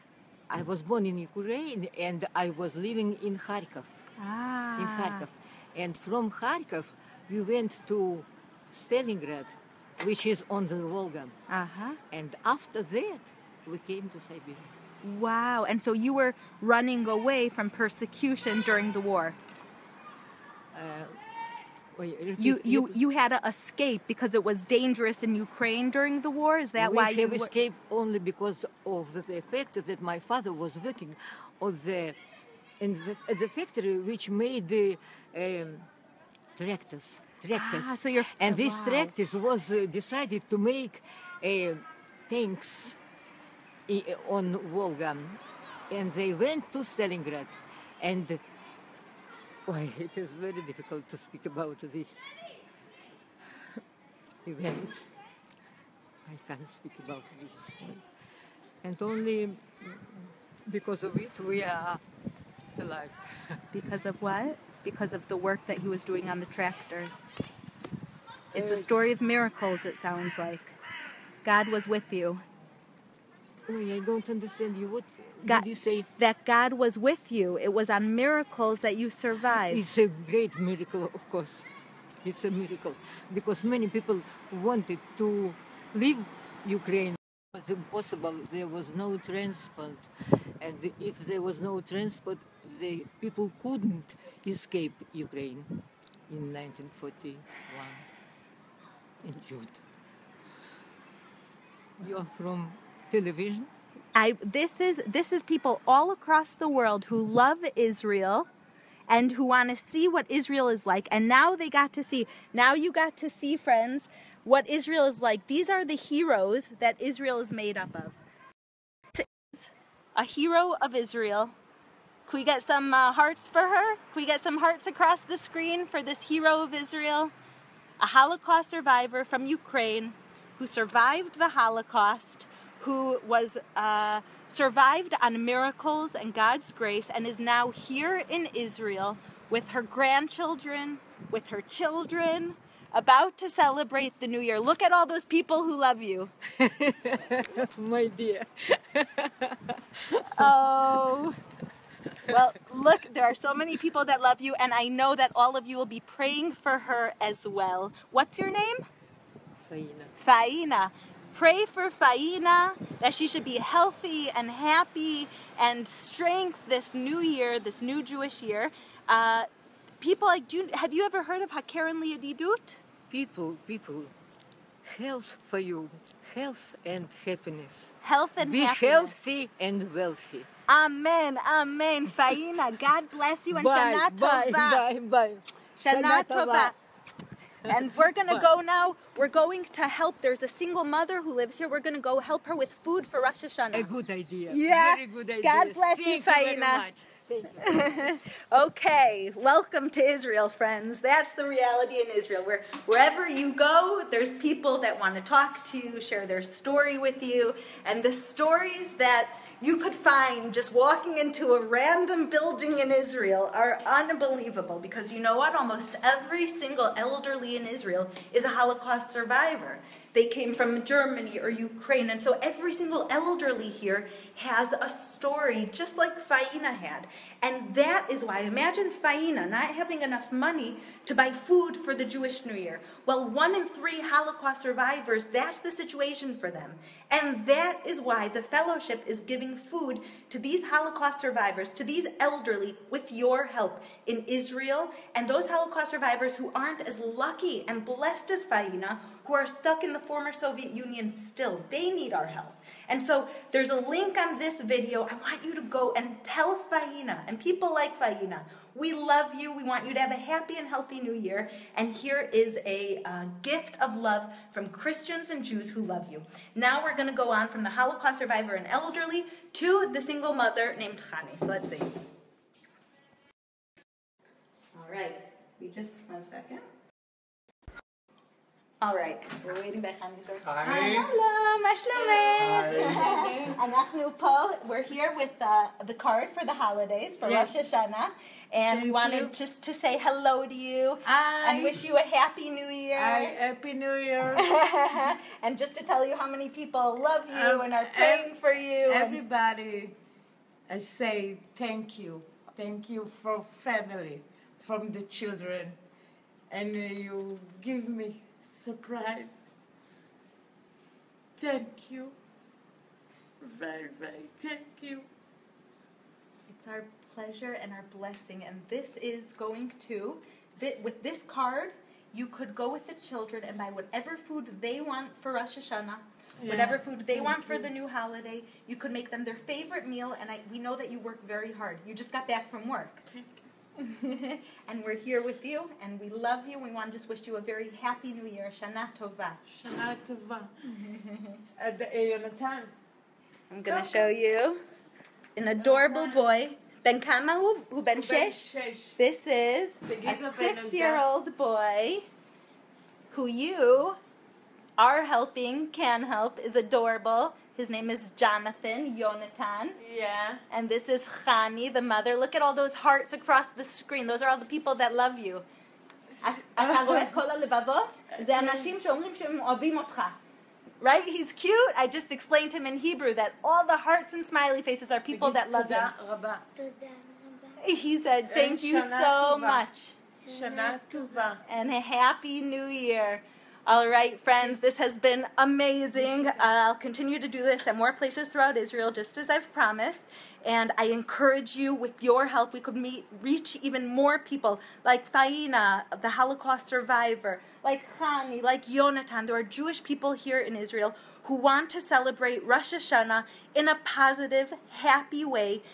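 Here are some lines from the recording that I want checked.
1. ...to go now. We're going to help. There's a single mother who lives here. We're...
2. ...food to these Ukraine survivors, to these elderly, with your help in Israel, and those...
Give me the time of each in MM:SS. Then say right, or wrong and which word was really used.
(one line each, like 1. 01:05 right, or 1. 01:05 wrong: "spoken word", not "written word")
1. 03:08 right
2. 03:59 wrong: "Holocaust", not "Ukraine".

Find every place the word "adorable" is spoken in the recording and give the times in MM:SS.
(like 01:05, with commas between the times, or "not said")
05:45, 05:56.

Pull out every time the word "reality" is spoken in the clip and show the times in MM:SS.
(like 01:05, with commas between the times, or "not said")
03:21.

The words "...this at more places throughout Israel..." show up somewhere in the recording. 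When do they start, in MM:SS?
06:27.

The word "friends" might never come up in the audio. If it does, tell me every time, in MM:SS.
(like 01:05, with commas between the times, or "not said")
01:53, 03:20, 06:24.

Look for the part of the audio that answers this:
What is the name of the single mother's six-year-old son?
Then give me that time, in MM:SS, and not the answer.
05:58.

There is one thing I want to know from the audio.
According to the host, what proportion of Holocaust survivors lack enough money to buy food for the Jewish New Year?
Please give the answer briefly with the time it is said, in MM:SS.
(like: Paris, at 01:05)
One in three, at 03:53.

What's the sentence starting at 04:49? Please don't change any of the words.
just to say hello to you I, and wish you a happy new year.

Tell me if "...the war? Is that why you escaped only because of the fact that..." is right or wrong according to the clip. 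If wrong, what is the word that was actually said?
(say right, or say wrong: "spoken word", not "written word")
right.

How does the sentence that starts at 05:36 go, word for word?
We want to just wish you a very happy new year.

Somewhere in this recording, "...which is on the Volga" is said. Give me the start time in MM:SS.
00:10.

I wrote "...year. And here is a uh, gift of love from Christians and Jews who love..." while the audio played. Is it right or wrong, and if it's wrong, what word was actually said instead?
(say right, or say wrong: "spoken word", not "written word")
right.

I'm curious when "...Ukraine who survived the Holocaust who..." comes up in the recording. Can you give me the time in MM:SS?
02:09.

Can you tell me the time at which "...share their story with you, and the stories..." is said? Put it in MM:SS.
03:26.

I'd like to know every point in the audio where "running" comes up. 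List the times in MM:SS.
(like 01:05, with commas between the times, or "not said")
00:16.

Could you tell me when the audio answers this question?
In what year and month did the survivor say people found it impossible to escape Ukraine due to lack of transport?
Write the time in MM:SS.
01:36.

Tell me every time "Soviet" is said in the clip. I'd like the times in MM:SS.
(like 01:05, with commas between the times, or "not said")
04:10.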